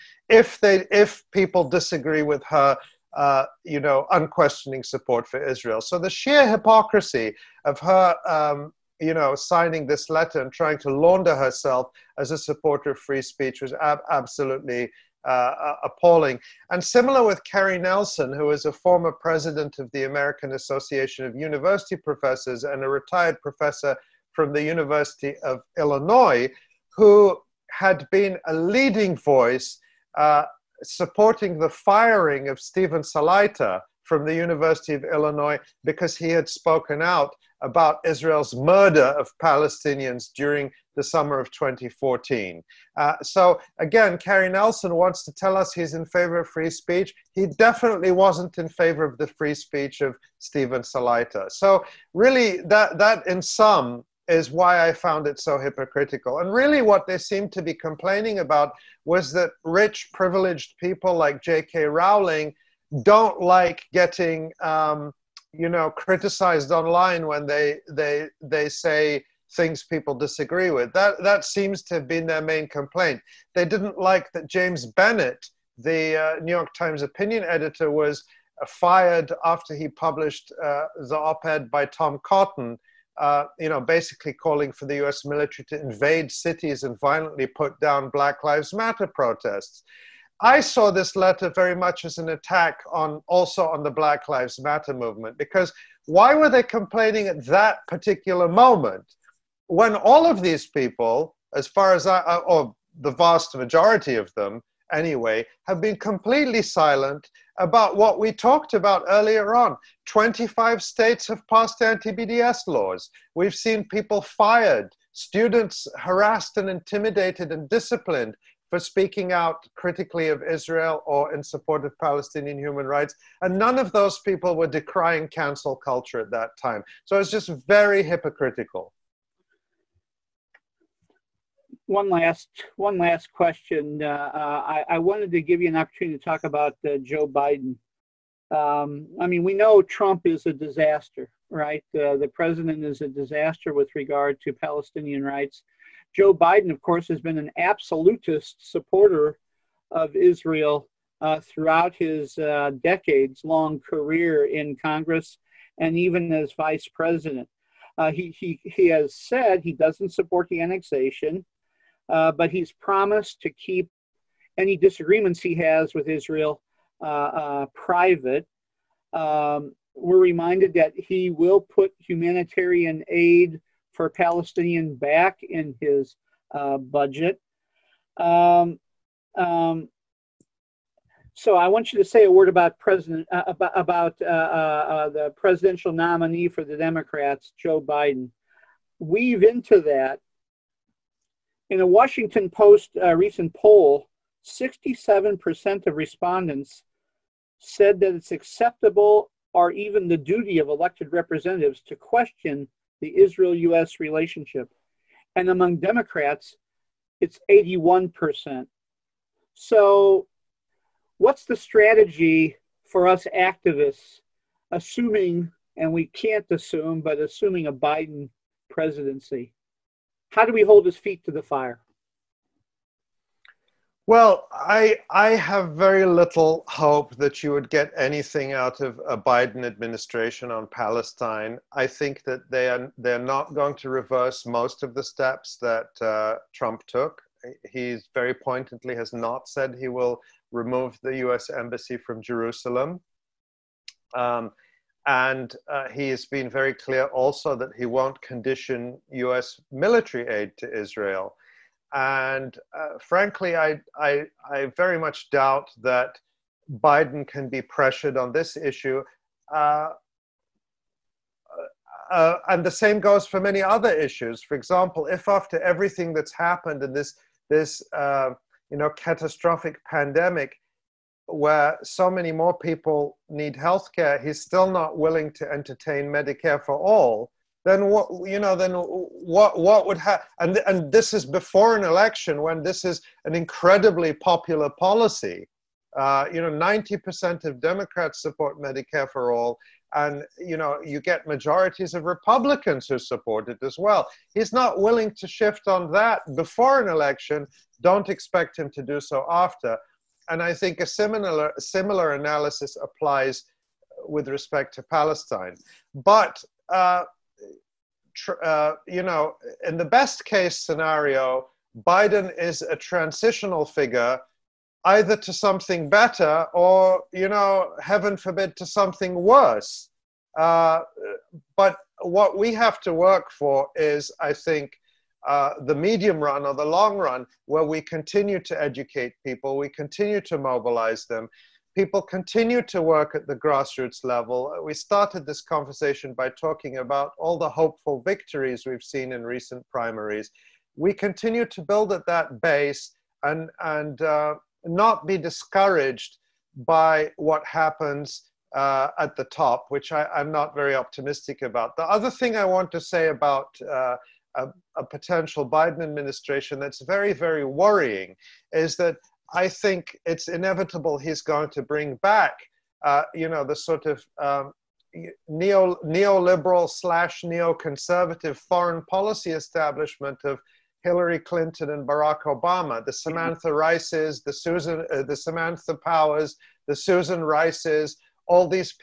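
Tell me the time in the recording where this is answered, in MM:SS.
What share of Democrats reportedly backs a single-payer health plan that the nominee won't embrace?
04:46.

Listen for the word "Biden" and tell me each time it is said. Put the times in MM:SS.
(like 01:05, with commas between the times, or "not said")
02:17, 02:26, 03:07, 03:37, 03:49, 04:16, 05:11, 05:55.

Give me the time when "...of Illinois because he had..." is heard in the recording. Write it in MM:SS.
00:34.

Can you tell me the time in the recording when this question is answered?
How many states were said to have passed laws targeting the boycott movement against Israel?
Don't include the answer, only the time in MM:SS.
01:50.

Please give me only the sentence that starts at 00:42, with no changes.
Uh, so again, Cary Nelson wants to tell us he's in favor of free speech.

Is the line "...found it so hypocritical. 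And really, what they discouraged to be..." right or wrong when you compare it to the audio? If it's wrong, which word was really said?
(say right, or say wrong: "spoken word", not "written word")
wrong: "seemed", not "discouraged".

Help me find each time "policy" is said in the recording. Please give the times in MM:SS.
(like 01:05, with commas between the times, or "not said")
04:44, 06:08.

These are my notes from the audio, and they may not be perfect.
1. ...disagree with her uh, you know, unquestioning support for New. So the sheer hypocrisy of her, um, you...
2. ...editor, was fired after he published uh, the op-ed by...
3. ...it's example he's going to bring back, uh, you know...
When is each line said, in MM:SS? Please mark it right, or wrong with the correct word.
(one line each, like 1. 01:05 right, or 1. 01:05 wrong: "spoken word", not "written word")
1. 00:01 wrong: "Israel", not "New"
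2. 01:17 right
3. 06:00 wrong: "inevitable", not "example".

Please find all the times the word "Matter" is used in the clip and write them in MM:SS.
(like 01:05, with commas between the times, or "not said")
01:28, 01:34.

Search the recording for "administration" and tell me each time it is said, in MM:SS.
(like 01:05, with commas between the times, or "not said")
03:49, 05:55.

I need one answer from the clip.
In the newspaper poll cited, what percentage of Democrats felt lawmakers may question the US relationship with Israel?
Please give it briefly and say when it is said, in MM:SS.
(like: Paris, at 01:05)
81%, at 03:27.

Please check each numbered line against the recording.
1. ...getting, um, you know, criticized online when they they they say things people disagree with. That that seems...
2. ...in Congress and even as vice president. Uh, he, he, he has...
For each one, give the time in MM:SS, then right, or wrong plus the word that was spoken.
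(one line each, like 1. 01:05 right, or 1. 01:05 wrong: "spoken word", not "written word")
1. 01:03 right
2. 02:34 right.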